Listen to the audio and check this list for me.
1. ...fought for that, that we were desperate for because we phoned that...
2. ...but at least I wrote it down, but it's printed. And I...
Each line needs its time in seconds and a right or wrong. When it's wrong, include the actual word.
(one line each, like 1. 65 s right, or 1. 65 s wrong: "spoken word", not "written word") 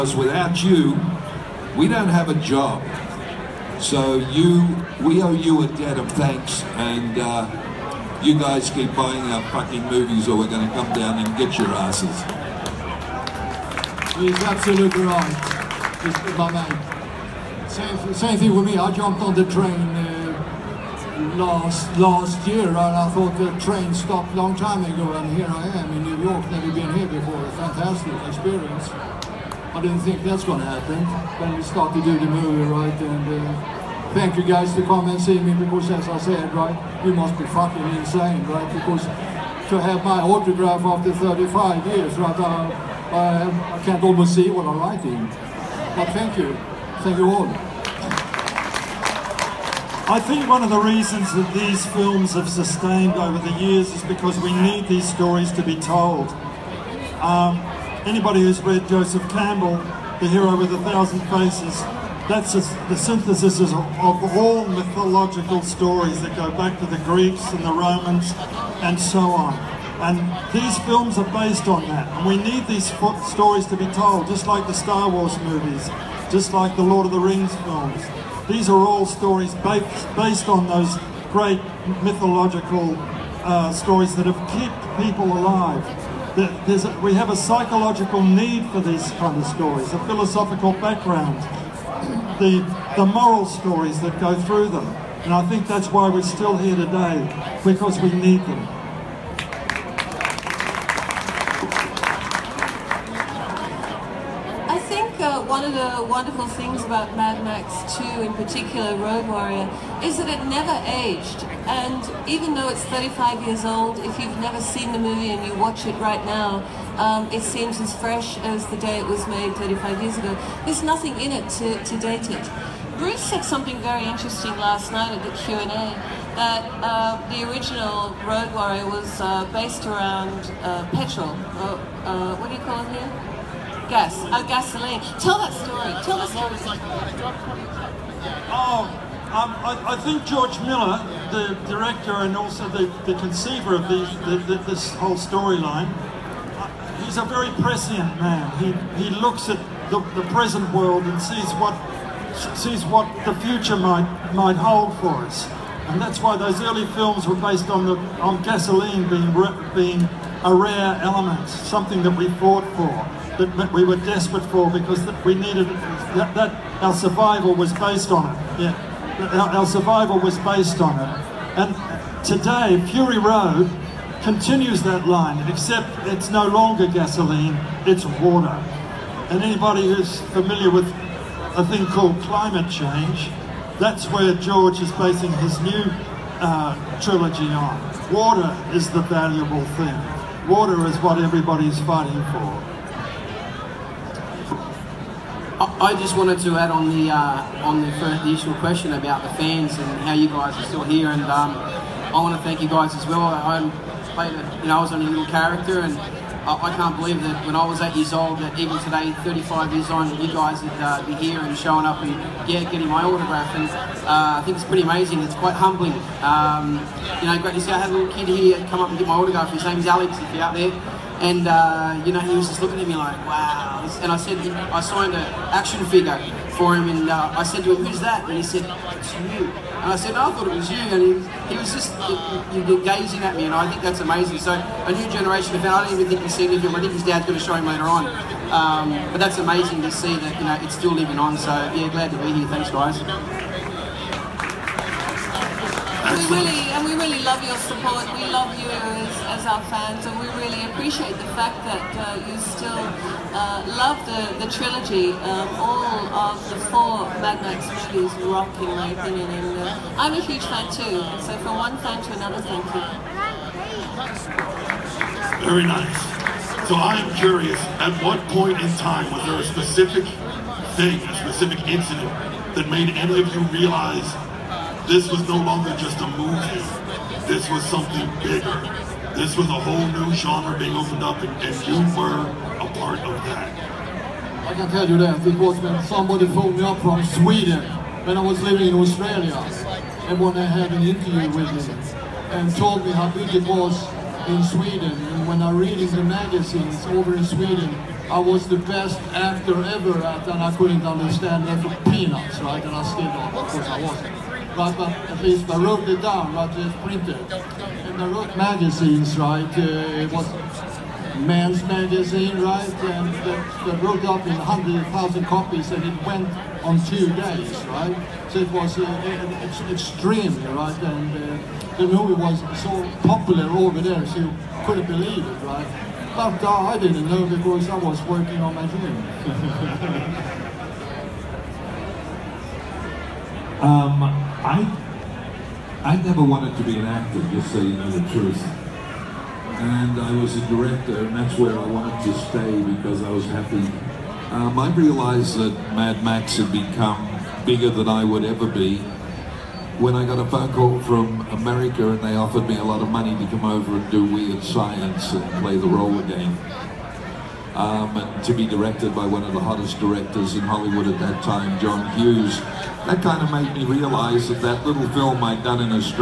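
1. 162 s wrong: "needed", not "phoned"
2. 304 s right.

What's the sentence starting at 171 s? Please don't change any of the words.
And today, Fury Road continues that line, except it's no longer gasoline, it's water.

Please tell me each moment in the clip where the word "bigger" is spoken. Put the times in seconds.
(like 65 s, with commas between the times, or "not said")
278 s, 347 s.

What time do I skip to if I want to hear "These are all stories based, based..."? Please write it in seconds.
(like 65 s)
78 s.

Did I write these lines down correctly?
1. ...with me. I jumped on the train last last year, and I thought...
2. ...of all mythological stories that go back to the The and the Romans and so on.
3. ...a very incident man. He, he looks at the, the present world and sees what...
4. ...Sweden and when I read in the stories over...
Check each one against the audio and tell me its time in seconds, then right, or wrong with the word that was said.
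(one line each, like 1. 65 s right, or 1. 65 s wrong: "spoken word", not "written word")
1. 18 s right
2. 63 s wrong: "Greeks", not "The"
3. 147 s wrong: "prescient", not "incident"
4. 294 s wrong: "magazines", not "stories".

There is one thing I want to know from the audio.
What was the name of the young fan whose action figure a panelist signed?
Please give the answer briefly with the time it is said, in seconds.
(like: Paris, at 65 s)
Alex, at 219 s.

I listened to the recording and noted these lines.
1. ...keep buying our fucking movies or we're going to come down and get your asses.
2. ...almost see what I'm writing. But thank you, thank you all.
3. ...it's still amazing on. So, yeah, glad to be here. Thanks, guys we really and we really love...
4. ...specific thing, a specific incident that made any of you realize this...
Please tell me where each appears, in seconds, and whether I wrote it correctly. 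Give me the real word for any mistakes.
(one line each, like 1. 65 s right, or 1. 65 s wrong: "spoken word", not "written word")
1. 8 s right
2. 44 s right
3. 240 s wrong: "living", not "amazing"
4. 269 s right.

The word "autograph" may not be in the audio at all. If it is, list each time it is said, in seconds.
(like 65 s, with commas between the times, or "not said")
40 s, 213 s, 219 s.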